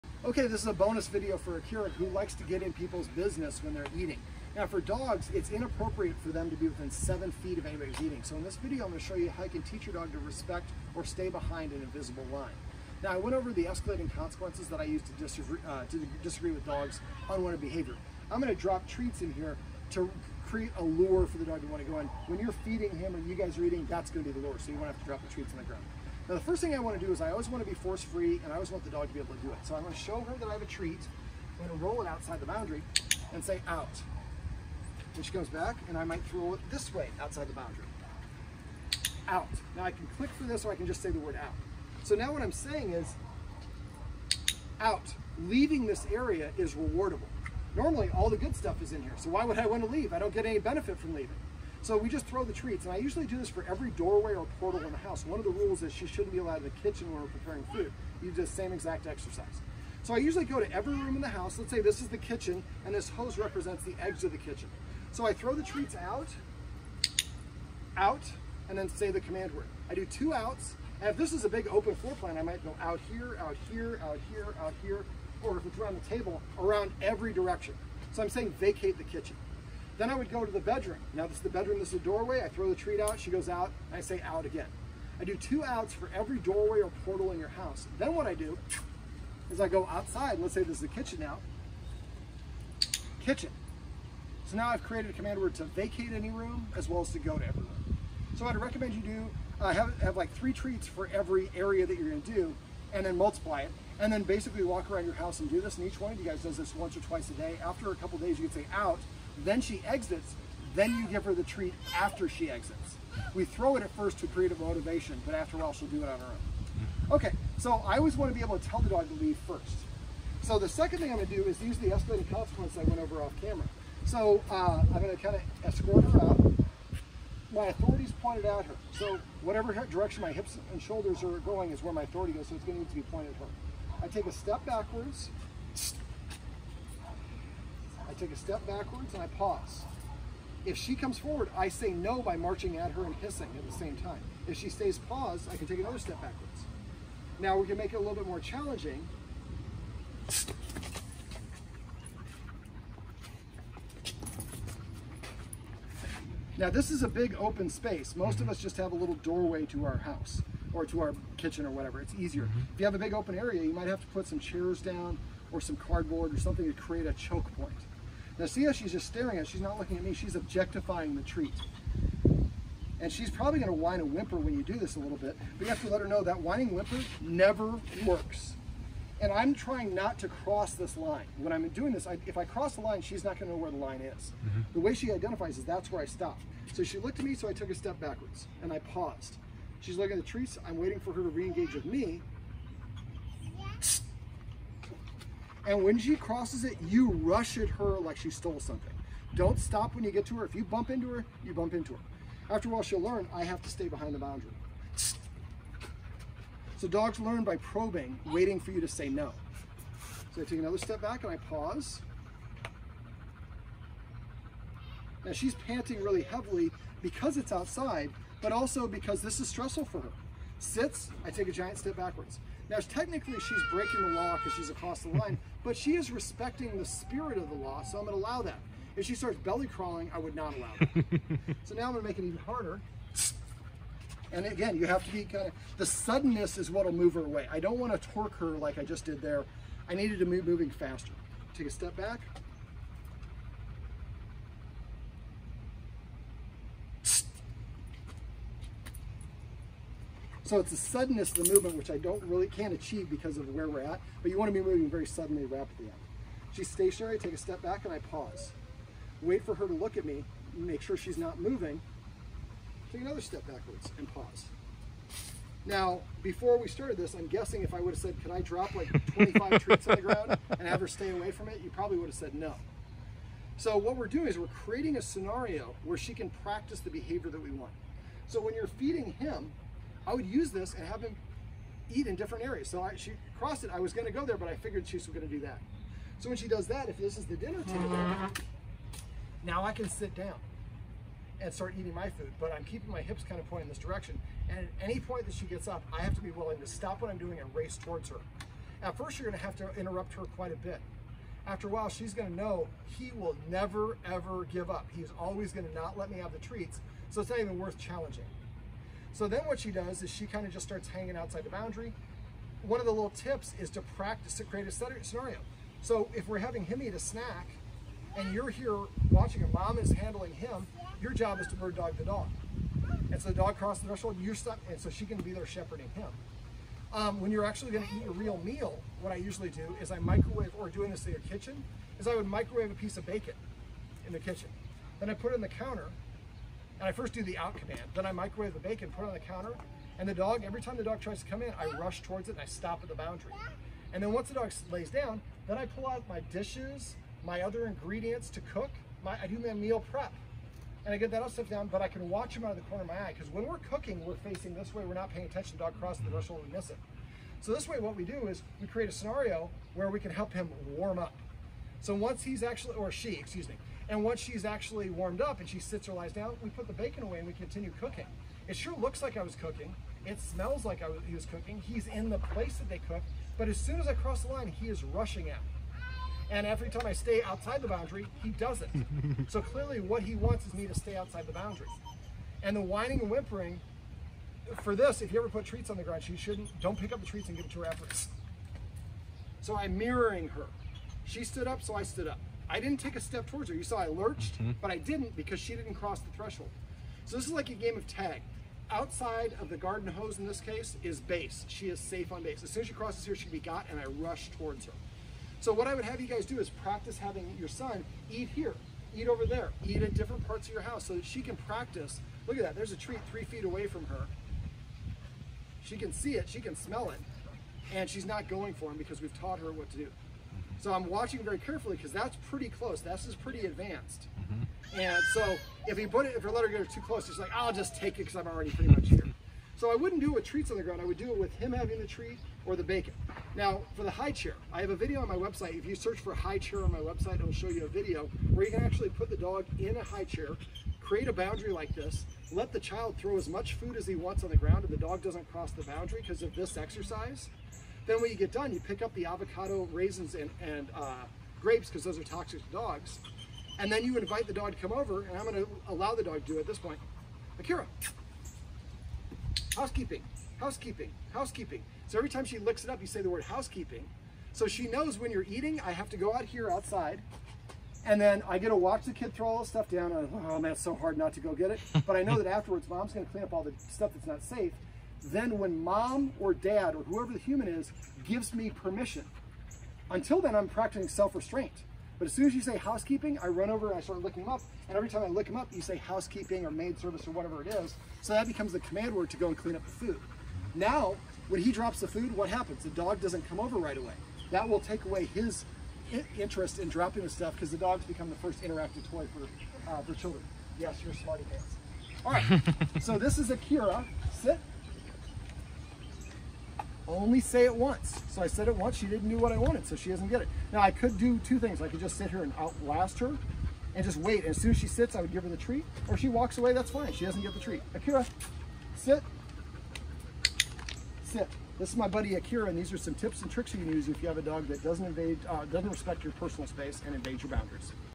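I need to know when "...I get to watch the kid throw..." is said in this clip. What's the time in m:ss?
7:48.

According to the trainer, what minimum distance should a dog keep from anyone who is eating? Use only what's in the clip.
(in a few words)
7 feet.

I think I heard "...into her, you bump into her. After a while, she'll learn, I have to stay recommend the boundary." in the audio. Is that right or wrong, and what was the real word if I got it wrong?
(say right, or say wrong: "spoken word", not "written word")
wrong: "behind", not "recommend".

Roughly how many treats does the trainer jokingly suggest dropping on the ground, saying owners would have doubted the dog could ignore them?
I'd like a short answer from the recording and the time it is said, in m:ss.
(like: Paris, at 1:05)
25, at 4:29.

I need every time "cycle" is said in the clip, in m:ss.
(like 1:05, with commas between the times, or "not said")
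not said.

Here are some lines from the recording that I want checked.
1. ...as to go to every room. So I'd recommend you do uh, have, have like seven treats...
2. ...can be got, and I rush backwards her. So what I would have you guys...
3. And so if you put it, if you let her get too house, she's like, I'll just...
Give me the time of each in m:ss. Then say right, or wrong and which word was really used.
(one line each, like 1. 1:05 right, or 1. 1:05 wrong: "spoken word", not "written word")
1. 1:37 wrong: "three", not "seven"
2. 6:43 wrong: "towards", not "backwards"
3. 7:04 wrong: "close", not "house".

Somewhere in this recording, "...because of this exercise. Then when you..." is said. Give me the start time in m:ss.
7:26.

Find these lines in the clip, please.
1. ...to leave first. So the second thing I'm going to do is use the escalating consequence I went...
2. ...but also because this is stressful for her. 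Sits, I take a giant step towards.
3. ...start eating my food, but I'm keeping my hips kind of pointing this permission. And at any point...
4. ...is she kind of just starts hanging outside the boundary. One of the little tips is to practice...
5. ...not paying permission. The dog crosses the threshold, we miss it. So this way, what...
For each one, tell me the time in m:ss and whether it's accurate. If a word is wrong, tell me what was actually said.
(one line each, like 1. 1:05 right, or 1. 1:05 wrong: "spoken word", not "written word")
1. 1:59 right
2. 3:38 wrong: "backwards", not "towards"
3. 4:51 wrong: "direction", not "permission"
4. 5:10 right
5. 5:54 wrong: "attention", not "permission".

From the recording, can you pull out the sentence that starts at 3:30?
So I take another step back and I pause.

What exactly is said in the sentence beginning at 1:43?
And then basically walk around your house and do this.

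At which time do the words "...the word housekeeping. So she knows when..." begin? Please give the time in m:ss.
7:43.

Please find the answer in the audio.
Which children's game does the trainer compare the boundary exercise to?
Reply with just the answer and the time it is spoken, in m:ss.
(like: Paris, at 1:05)
tag, at 6:37.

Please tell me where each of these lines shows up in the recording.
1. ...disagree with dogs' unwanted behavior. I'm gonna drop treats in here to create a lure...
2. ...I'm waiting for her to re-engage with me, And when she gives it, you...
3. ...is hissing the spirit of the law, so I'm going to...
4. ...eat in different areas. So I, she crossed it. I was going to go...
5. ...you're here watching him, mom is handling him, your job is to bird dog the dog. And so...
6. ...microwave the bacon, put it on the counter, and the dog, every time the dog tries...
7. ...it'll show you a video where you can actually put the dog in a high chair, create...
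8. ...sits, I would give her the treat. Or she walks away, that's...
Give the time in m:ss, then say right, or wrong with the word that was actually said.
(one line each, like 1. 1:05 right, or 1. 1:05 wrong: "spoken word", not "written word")
1. 0:16 right
2. 3:10 wrong: "crosses", not "gives"
3. 3:45 wrong: "respecting", not "hissing"
4. 4:41 right
5. 5:18 right
6. 5:38 right
7. 7:17 right
8. 8:34 right.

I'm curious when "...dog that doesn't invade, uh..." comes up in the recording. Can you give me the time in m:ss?
8:44.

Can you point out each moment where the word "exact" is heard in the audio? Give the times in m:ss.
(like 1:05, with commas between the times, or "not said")
0:58.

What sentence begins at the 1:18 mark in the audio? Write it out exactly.
So I'm saying vacate the kitchen.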